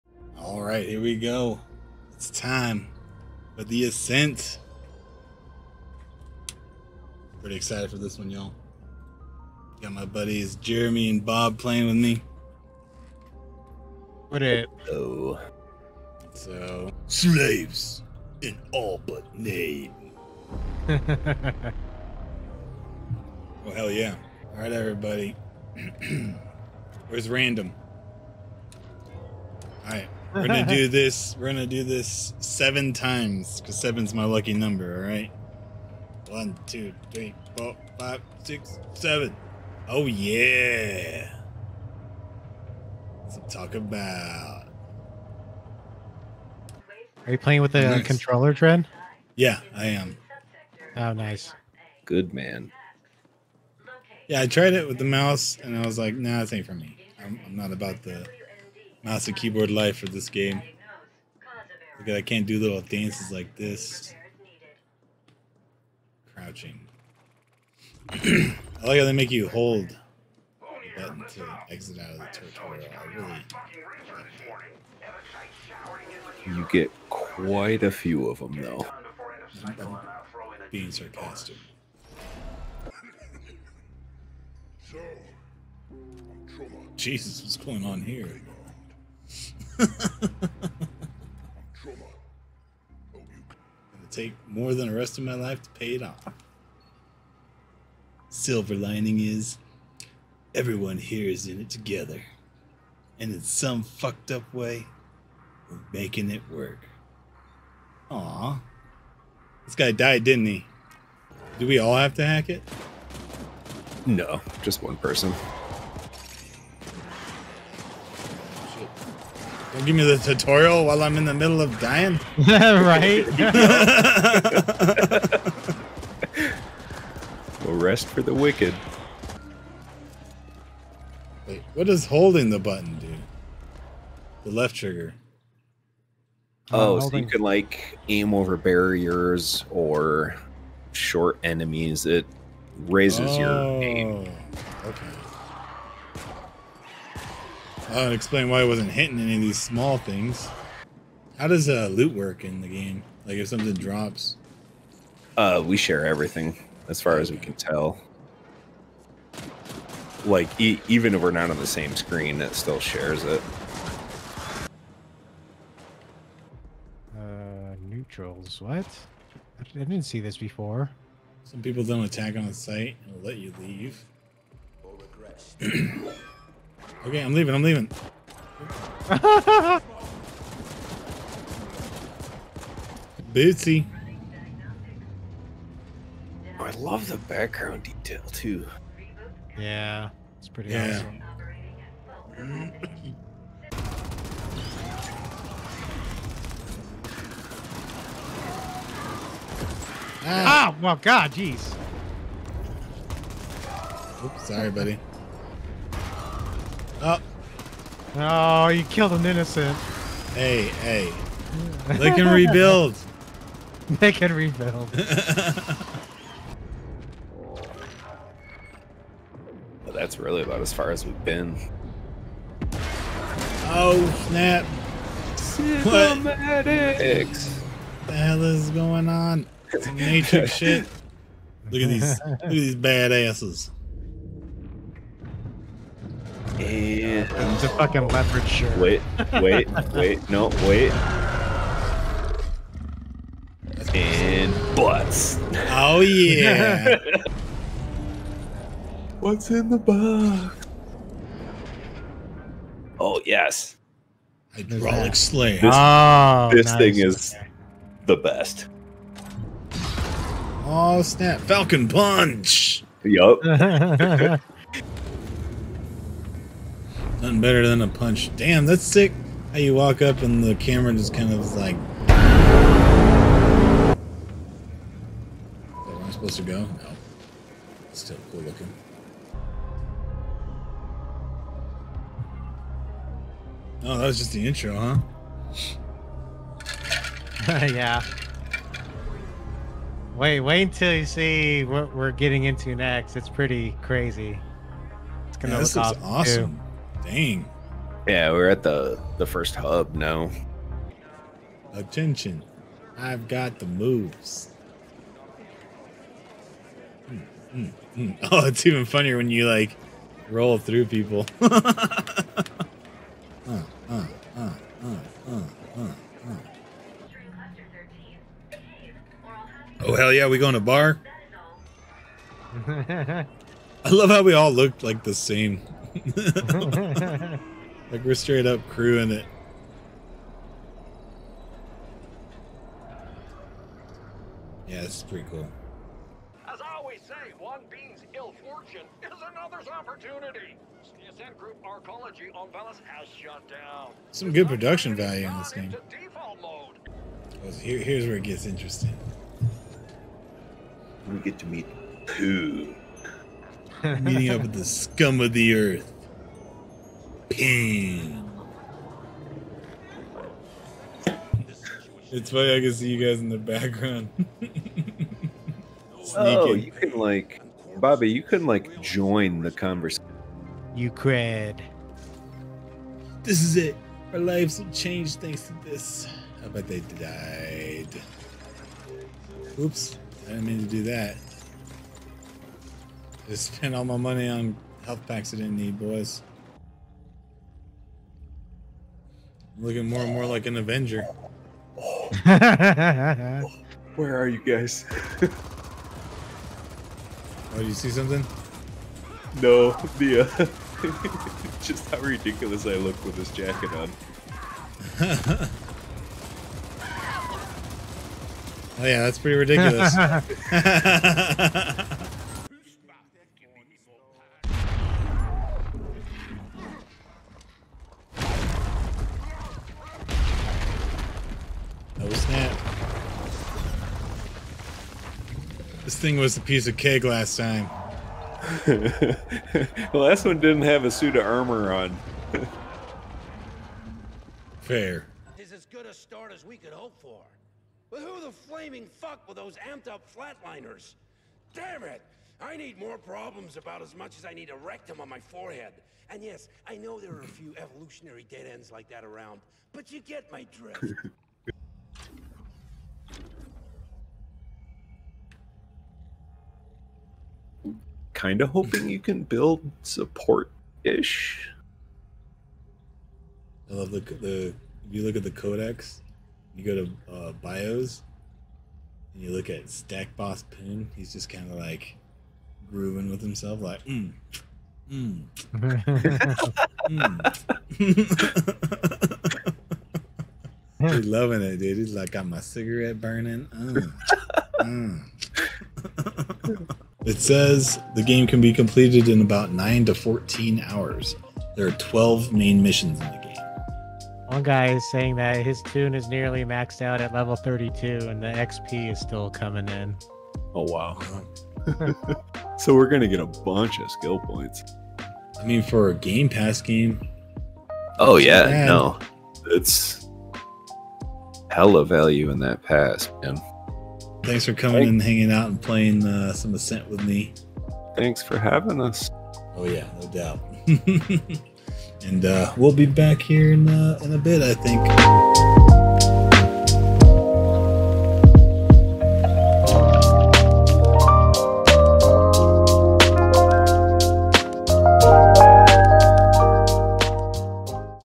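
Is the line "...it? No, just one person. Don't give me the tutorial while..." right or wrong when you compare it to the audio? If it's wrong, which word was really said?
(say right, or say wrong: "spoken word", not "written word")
right.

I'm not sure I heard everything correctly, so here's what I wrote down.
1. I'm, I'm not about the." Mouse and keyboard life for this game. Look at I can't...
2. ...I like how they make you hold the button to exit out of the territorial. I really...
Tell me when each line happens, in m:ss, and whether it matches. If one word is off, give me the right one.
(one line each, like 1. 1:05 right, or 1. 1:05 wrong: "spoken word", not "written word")
1. 0:57 right
2. 1:08 right.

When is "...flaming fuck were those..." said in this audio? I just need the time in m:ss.
7:18.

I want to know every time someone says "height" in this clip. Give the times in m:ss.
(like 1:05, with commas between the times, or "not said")
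not said.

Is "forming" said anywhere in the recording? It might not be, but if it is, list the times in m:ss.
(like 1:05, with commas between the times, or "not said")
not said.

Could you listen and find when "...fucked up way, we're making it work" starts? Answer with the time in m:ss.
1:43.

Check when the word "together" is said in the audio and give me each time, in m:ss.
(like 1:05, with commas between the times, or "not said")
1:41.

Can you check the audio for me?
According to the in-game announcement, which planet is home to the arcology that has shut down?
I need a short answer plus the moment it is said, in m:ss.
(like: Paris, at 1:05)
Veles, at 5:42.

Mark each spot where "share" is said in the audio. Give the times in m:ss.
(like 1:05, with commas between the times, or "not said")
2:35, 2:42.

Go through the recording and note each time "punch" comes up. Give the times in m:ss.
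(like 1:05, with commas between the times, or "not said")
4:21, 4:27.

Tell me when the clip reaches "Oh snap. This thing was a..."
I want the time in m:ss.
7:02.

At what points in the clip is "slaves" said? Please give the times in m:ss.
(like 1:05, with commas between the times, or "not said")
0:17, 4:15.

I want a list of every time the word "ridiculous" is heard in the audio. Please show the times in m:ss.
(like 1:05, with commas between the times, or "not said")
6:41, 6:49.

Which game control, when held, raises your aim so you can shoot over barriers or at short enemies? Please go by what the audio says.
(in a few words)
left trigger.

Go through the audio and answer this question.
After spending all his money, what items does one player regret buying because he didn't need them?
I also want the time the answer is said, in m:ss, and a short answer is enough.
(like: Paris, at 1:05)
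health packs, at 6:24.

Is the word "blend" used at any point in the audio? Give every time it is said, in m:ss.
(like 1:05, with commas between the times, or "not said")
not said.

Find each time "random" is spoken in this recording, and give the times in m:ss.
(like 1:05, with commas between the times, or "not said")
0:27.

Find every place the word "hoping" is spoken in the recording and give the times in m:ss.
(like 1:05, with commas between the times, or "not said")
7:38.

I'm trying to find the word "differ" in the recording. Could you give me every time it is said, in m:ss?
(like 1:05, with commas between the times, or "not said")
not said.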